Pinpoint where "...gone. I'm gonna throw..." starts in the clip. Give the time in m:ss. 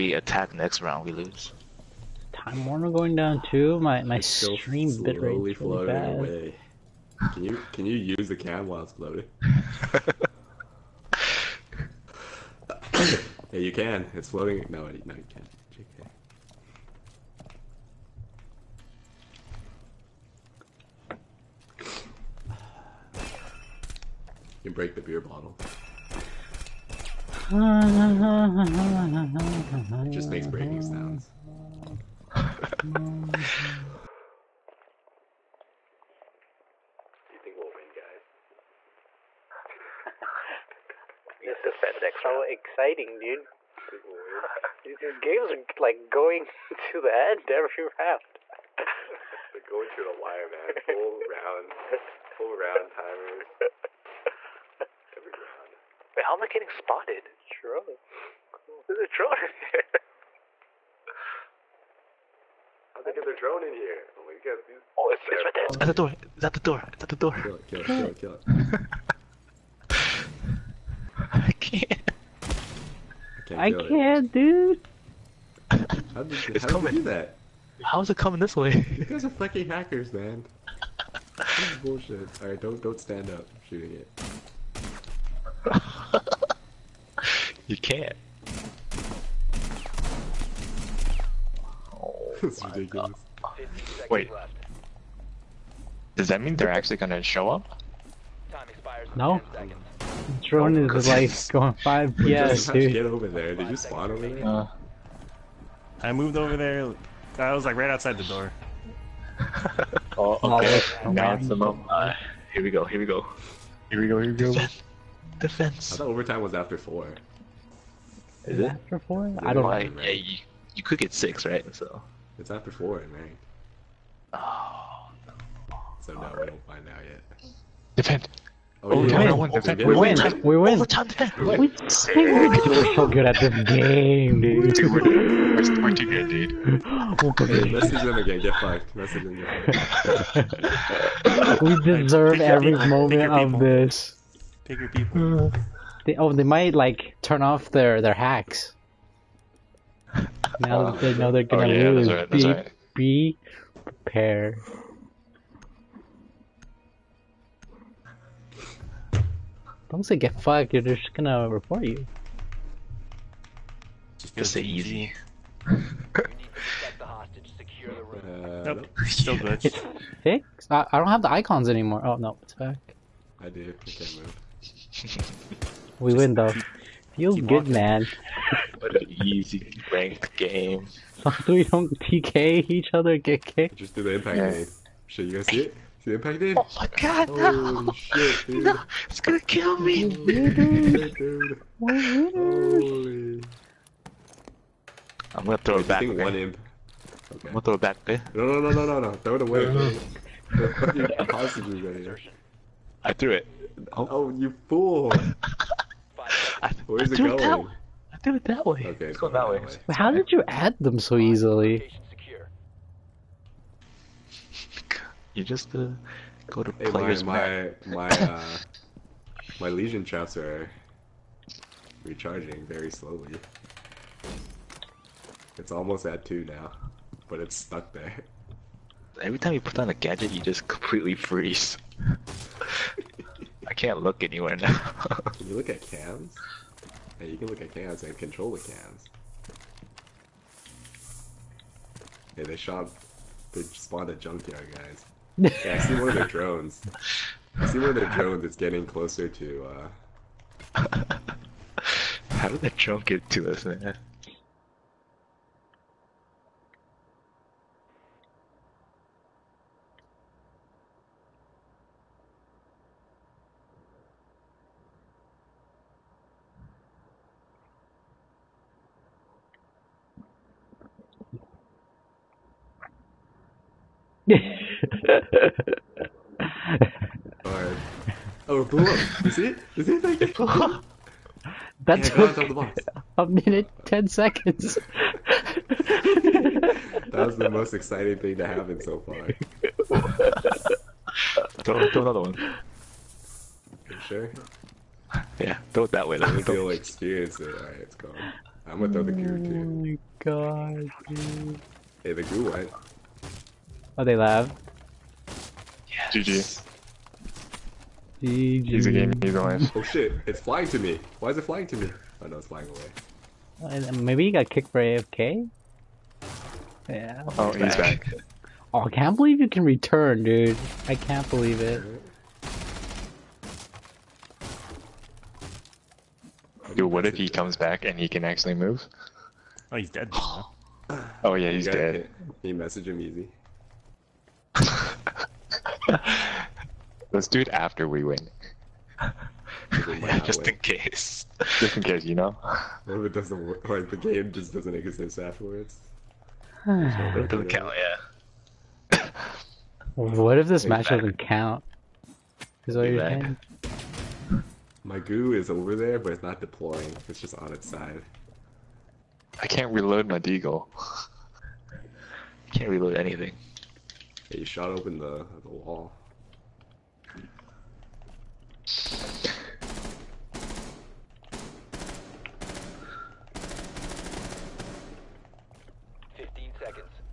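4:57.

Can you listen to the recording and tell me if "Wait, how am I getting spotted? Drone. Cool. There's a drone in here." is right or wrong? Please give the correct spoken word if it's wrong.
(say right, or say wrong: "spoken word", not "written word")
right.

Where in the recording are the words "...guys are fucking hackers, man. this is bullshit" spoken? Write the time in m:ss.
1:19.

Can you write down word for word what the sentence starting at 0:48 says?
They're going to the wire, man.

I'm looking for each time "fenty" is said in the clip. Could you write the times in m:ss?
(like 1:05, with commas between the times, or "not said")
not said.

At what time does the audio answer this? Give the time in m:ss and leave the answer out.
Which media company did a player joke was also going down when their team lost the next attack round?
0:02.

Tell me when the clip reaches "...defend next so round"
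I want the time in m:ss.
0:41.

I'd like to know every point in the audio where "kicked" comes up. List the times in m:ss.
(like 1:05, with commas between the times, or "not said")
3:03, 5:14.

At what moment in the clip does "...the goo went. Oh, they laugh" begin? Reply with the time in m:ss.
5:02.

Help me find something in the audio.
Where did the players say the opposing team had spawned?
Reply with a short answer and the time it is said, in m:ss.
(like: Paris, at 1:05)
junkyard, at 4:04.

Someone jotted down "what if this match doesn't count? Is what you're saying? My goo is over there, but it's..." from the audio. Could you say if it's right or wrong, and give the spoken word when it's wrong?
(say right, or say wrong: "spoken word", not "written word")
right.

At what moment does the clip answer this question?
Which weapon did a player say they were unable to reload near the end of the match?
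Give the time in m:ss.
6:00.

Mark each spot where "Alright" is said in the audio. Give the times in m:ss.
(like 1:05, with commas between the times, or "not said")
1:22, 4:57.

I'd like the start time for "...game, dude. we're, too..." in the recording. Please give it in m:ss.
2:13.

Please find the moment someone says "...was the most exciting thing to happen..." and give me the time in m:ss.
4:47.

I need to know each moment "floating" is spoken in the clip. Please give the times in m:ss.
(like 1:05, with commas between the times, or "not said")
0:08, 0:14.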